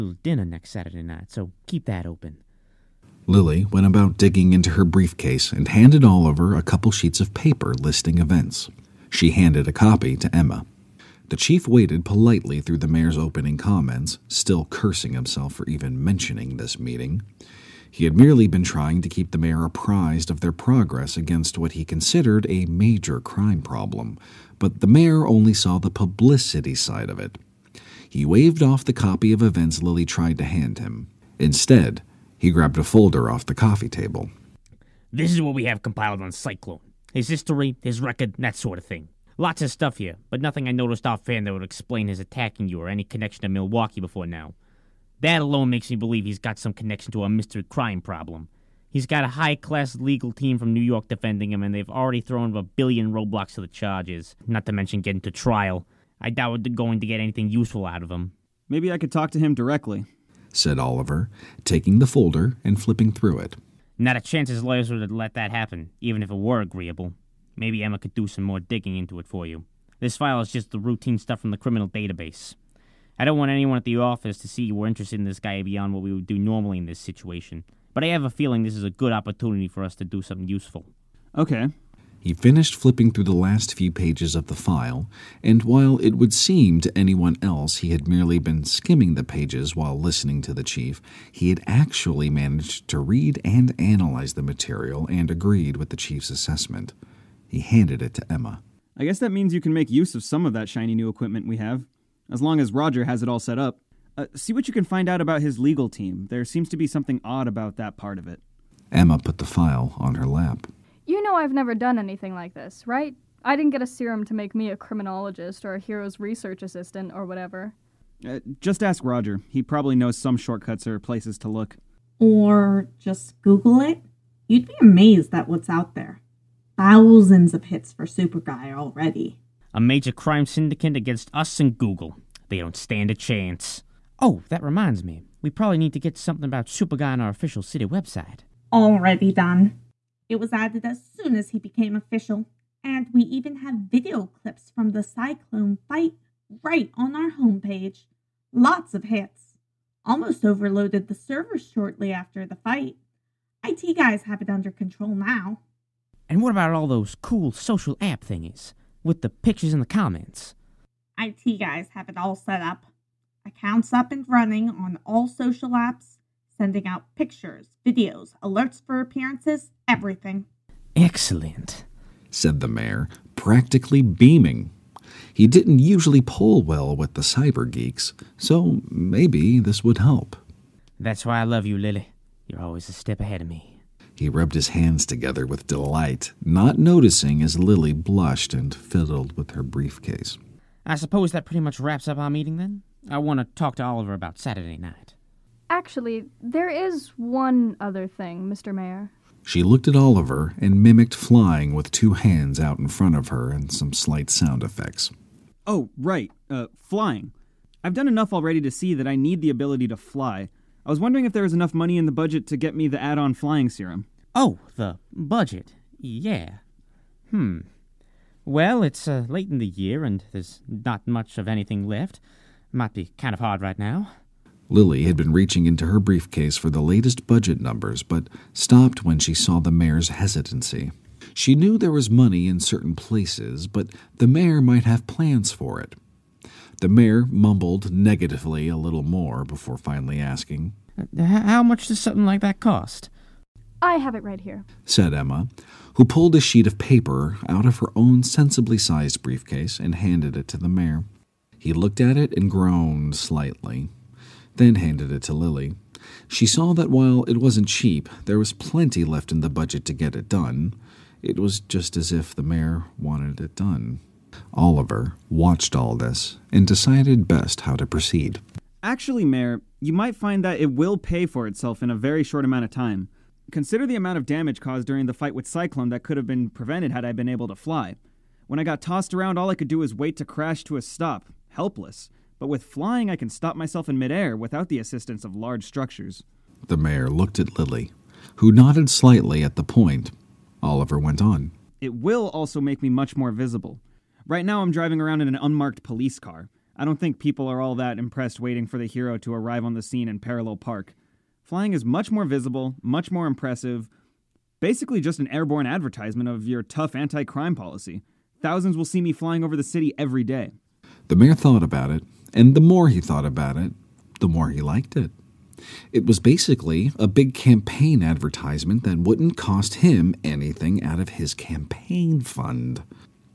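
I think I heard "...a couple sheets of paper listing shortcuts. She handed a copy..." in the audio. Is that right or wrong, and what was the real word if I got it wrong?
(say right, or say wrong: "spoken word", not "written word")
wrong: "events", not "shortcuts".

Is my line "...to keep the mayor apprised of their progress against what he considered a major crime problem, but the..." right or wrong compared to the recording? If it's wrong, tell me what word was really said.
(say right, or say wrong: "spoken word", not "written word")
right.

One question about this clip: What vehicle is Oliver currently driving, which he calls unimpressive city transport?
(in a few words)
unmarked police car.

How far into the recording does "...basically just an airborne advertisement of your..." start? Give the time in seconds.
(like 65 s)
304 s.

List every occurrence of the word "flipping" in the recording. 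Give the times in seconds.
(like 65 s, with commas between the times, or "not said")
62 s, 82 s.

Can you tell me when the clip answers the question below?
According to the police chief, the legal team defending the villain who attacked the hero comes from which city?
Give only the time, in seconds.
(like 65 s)
50 s.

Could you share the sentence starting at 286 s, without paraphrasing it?
The mayor looked at Lily, who nodded slightly at the point.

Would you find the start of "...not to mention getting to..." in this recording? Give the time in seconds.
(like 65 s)
54 s.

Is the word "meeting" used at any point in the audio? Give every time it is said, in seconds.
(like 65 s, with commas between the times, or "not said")
16 s, 192 s.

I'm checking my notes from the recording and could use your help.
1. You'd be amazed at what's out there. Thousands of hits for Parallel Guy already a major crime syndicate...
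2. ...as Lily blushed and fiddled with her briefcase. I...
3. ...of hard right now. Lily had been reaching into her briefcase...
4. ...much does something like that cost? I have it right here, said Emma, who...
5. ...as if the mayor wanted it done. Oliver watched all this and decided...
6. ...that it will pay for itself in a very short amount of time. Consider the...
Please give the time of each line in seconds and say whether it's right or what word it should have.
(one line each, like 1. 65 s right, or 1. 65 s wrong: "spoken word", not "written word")
1. 124 s wrong: "Super", not "Parallel"
2. 187 s right
3. 223 s right
4. 241 s right
5. 261 s right
6. 270 s right.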